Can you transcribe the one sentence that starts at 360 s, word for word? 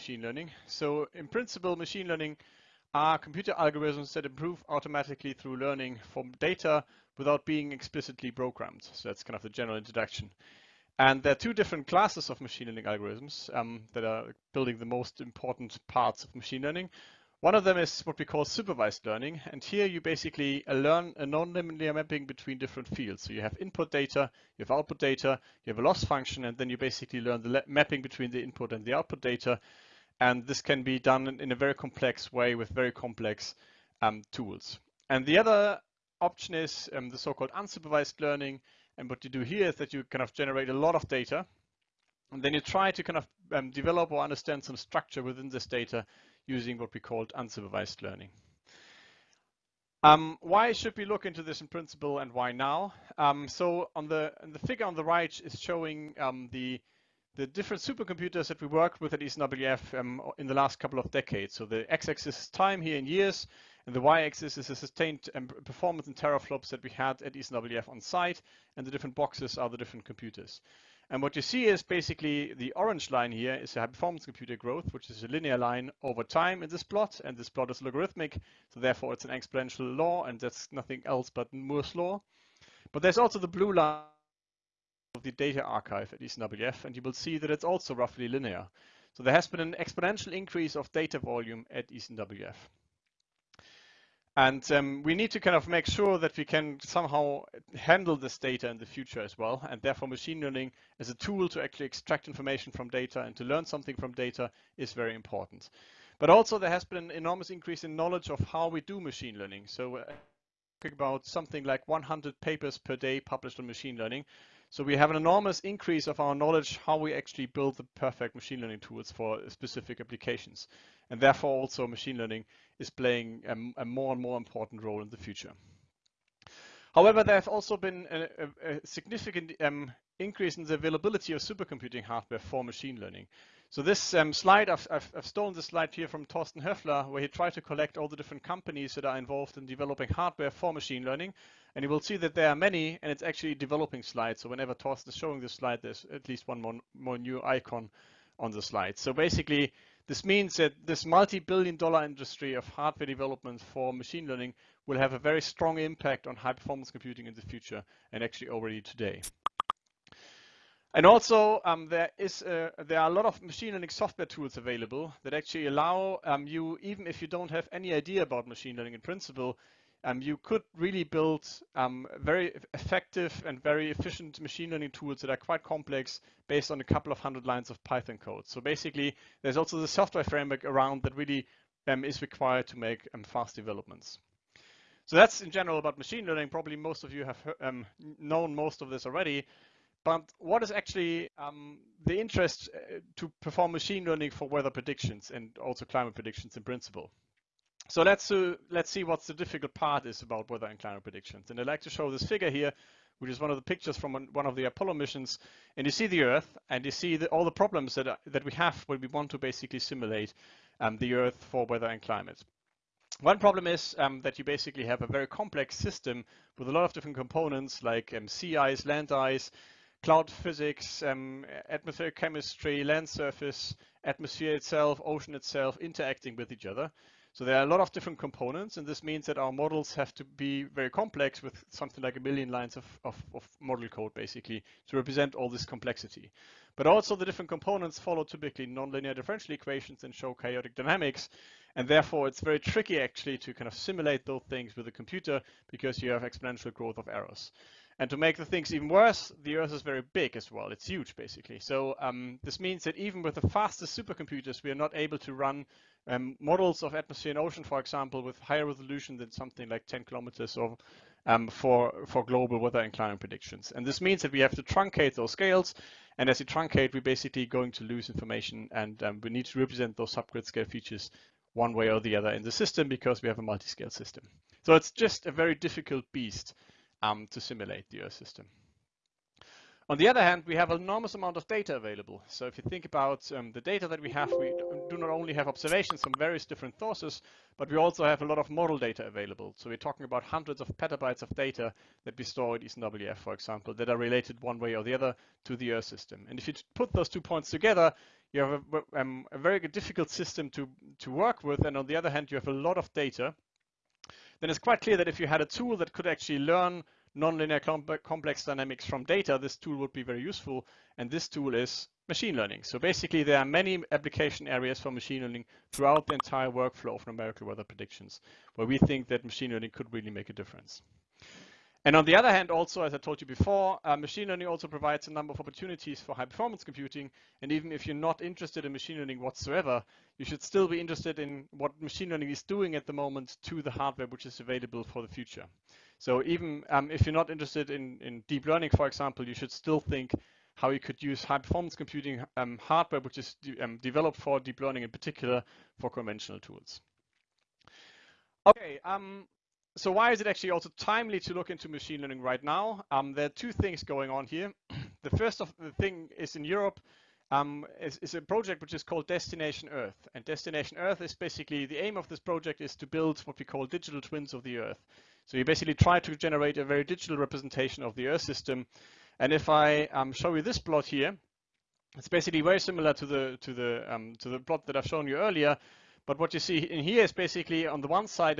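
And Destination Earth is basically, the aim of this project is to build what we call digital twins of the Earth.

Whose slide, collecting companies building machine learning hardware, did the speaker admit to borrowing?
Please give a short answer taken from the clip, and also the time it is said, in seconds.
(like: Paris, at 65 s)
Torsten Höfler, at 136 s.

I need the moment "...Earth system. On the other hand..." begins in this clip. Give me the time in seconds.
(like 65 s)
278 s.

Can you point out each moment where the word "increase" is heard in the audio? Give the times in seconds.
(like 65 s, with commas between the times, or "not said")
90 s, 107 s, 115 s, 130 s.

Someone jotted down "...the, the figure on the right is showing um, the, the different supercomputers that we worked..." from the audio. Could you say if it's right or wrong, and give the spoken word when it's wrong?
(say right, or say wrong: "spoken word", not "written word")
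right.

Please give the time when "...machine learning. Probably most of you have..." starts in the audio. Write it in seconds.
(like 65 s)
185 s.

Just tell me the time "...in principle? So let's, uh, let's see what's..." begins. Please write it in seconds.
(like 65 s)
196 s.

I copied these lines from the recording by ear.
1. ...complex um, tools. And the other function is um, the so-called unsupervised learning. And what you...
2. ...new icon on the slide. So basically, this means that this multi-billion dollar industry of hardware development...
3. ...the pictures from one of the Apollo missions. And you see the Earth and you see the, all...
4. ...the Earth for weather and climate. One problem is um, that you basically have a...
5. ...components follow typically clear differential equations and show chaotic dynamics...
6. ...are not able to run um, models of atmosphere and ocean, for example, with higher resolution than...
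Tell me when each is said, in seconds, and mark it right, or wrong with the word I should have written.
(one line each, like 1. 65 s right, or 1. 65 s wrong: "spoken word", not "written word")
1. 32 s wrong: "option", not "function"
2. 147 s right
3. 203 s right
4. 210 s right
5. 237 s wrong: "nonlinear", not "clear"
6. 254 s right.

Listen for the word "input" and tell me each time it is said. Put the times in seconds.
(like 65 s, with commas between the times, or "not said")
23 s, 28 s.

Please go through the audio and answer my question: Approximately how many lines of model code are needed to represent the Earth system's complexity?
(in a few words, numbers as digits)
a million.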